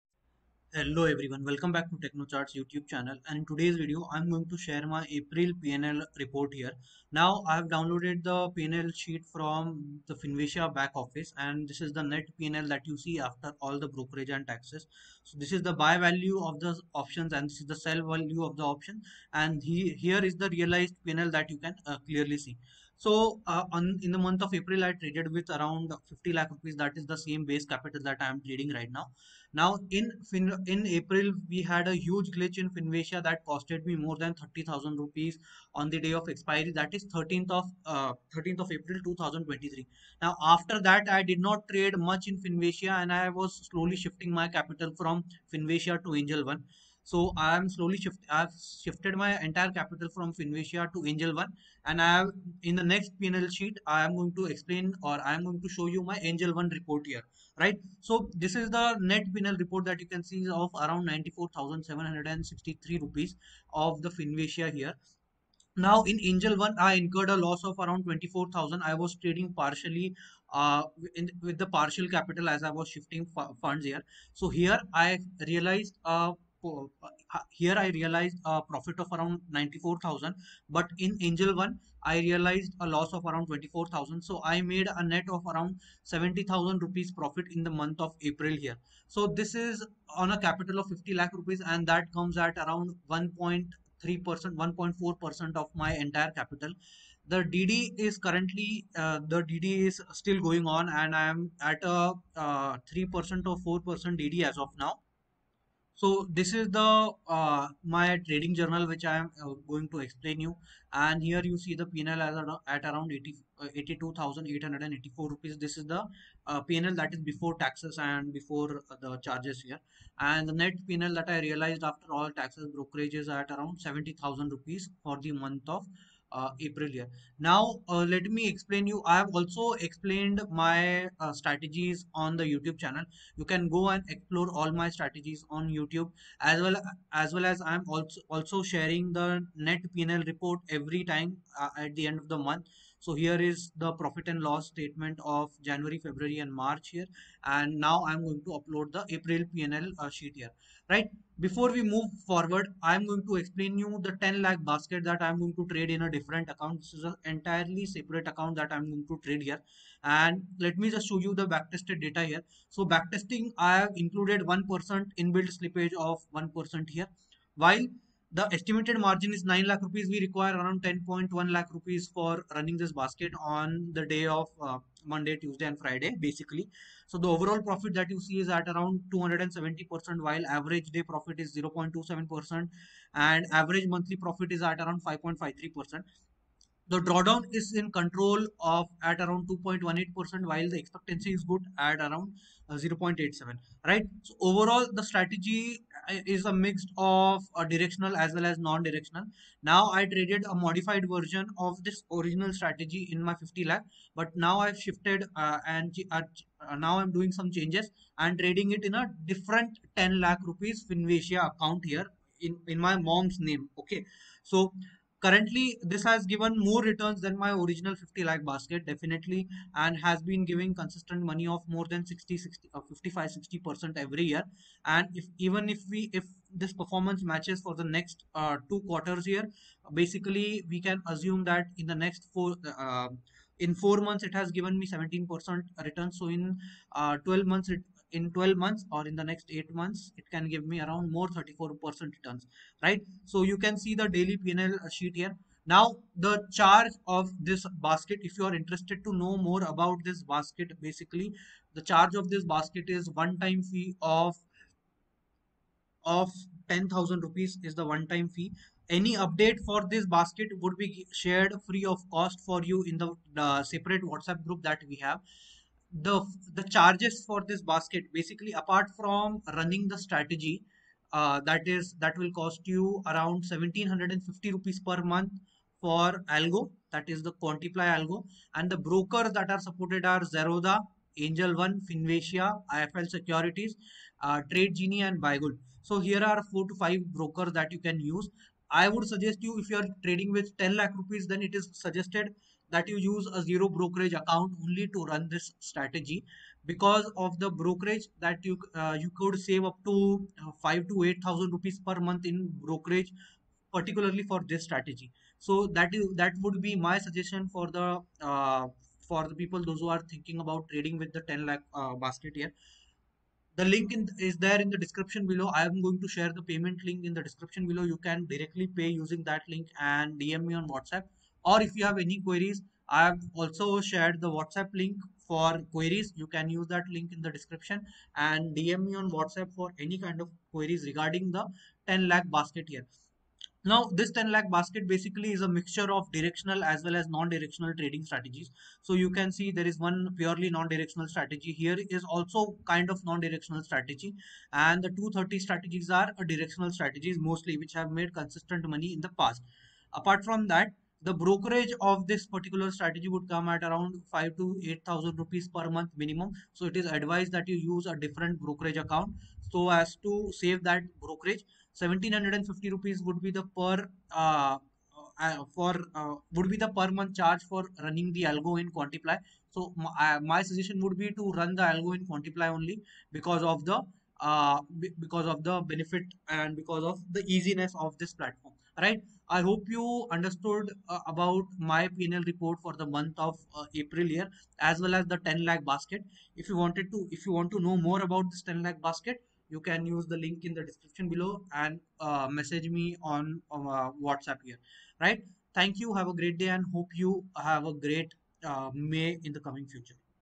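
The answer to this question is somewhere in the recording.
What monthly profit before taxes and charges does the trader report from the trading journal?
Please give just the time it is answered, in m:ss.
1:53.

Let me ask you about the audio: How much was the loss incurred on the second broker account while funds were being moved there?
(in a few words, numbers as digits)
around 24,000 rupees.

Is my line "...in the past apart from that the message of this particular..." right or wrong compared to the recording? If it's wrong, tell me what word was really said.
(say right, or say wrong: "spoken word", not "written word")
wrong: "brokerage", not "message".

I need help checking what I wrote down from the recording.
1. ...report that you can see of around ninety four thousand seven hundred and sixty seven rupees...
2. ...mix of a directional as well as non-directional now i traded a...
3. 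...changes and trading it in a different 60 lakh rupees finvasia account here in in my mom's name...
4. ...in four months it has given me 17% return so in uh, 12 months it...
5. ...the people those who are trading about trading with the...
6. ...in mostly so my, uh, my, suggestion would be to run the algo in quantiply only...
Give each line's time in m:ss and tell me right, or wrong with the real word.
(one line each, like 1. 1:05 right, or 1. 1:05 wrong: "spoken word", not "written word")
1. 0:59 wrong: "three", not "seven"
2. 3:16 right
3. 3:27 wrong: "10", not "60"
4. 3:53 right
5. 5:09 wrong: "thinking", not "trading"
6. 6:08 wrong: "quantiply", not "mostly".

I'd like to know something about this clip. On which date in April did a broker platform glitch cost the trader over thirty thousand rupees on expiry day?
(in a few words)
13th of April 2023.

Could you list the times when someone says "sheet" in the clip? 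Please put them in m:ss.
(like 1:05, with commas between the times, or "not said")
0:08, 0:53, 2:30, 4:04.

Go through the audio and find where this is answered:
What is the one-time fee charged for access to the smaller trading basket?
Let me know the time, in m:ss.
4:16.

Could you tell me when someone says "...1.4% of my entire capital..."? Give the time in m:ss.
1:34.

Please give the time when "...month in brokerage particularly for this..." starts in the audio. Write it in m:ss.
5:02.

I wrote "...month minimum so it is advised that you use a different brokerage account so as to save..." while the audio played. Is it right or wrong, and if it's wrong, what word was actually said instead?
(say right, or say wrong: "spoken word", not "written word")
right.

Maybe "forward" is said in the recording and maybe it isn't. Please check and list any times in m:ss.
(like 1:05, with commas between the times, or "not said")
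2:32.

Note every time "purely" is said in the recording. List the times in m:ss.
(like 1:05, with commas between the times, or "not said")
5:40.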